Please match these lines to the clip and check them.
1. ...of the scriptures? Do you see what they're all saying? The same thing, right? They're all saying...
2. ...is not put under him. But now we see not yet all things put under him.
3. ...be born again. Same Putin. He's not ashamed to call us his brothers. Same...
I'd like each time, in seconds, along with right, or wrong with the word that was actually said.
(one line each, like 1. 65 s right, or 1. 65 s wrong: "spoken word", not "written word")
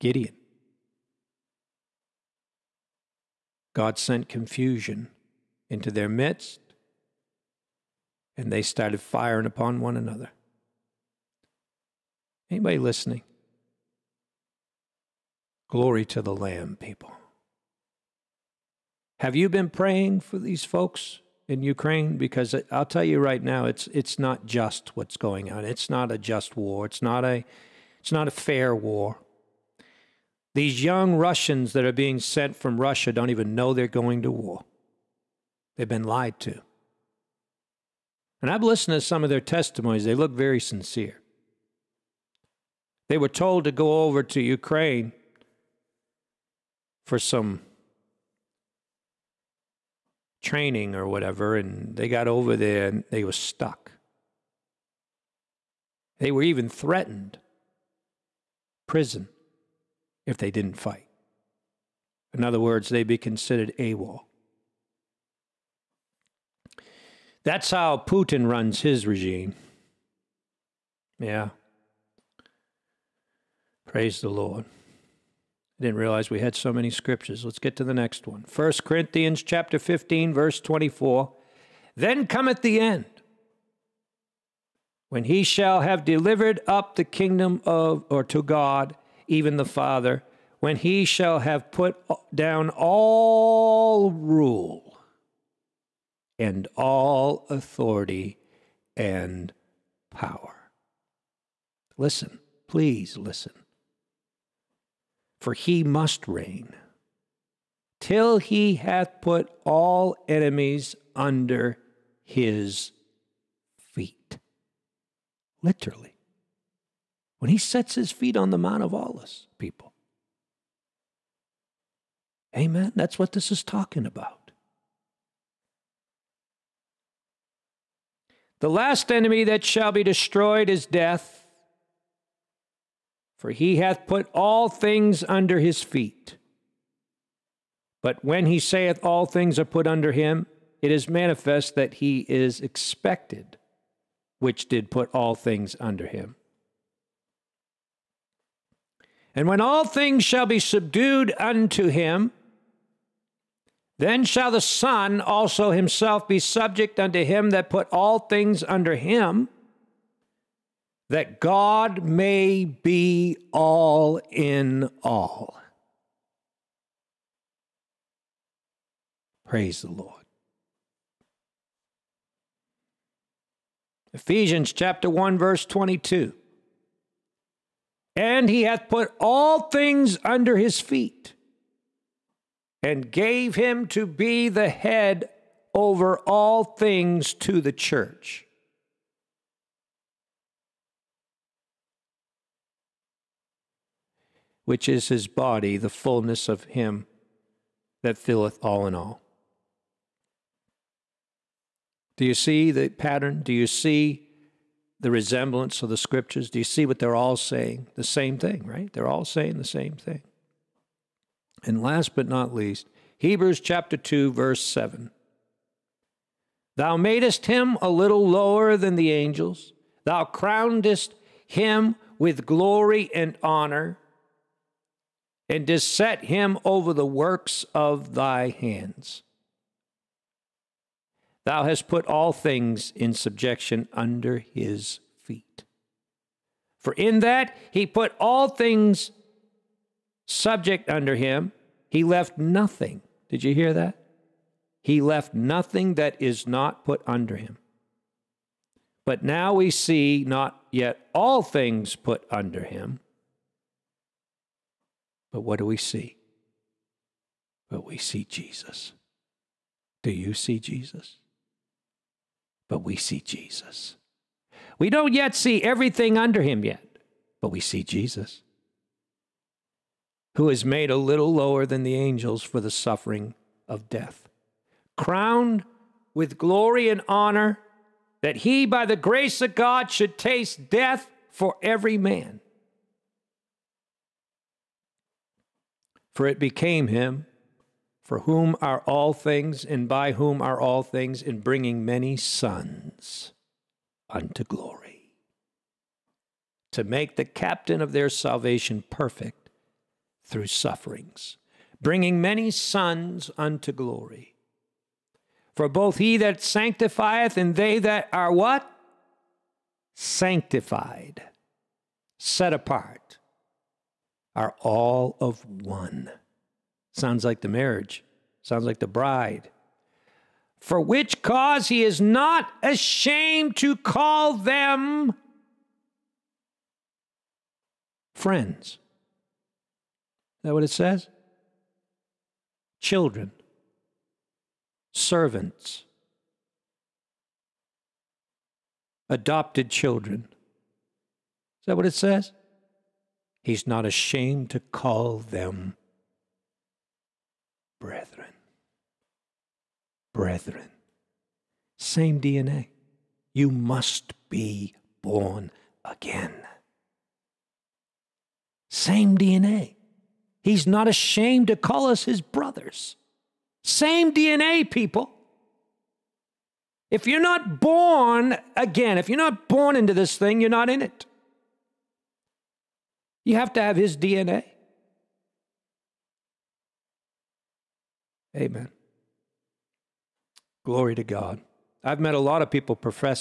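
1. 205 s right
2. 246 s right
3. 354 s wrong: "DNA", not "Putin".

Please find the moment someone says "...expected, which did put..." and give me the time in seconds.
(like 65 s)
142 s.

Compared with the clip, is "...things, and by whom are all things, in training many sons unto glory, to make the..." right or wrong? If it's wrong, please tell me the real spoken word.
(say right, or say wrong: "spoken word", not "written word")
wrong: "bringing", not "training".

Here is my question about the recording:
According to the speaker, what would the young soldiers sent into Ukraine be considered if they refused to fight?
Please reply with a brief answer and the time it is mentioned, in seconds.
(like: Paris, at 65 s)
AWOL, at 63 s.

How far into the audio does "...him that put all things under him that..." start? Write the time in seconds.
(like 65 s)
157 s.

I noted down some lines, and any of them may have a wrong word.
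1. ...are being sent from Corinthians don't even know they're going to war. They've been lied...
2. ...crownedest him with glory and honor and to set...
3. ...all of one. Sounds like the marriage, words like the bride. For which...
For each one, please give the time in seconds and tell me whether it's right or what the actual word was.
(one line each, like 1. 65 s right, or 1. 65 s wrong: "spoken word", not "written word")
1. 31 s wrong: "Russia", not "Corinthians"
2. 220 s right
3. 314 s wrong: "sounds", not "words".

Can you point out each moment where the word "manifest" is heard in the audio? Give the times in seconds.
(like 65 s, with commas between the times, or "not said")
141 s.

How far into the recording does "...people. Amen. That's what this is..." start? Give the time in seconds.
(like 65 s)
119 s.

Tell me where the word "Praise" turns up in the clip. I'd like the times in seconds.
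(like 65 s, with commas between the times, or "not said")
73 s, 169 s.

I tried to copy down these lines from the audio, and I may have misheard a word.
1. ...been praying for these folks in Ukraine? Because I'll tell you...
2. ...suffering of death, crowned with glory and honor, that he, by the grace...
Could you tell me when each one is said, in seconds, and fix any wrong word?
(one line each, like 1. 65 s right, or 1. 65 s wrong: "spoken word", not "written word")
1. 19 s right
2. 272 s right.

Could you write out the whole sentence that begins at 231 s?
Thou hast put all things in subjection under his feet.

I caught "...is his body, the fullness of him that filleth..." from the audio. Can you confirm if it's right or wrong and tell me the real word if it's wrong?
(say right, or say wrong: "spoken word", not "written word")
right.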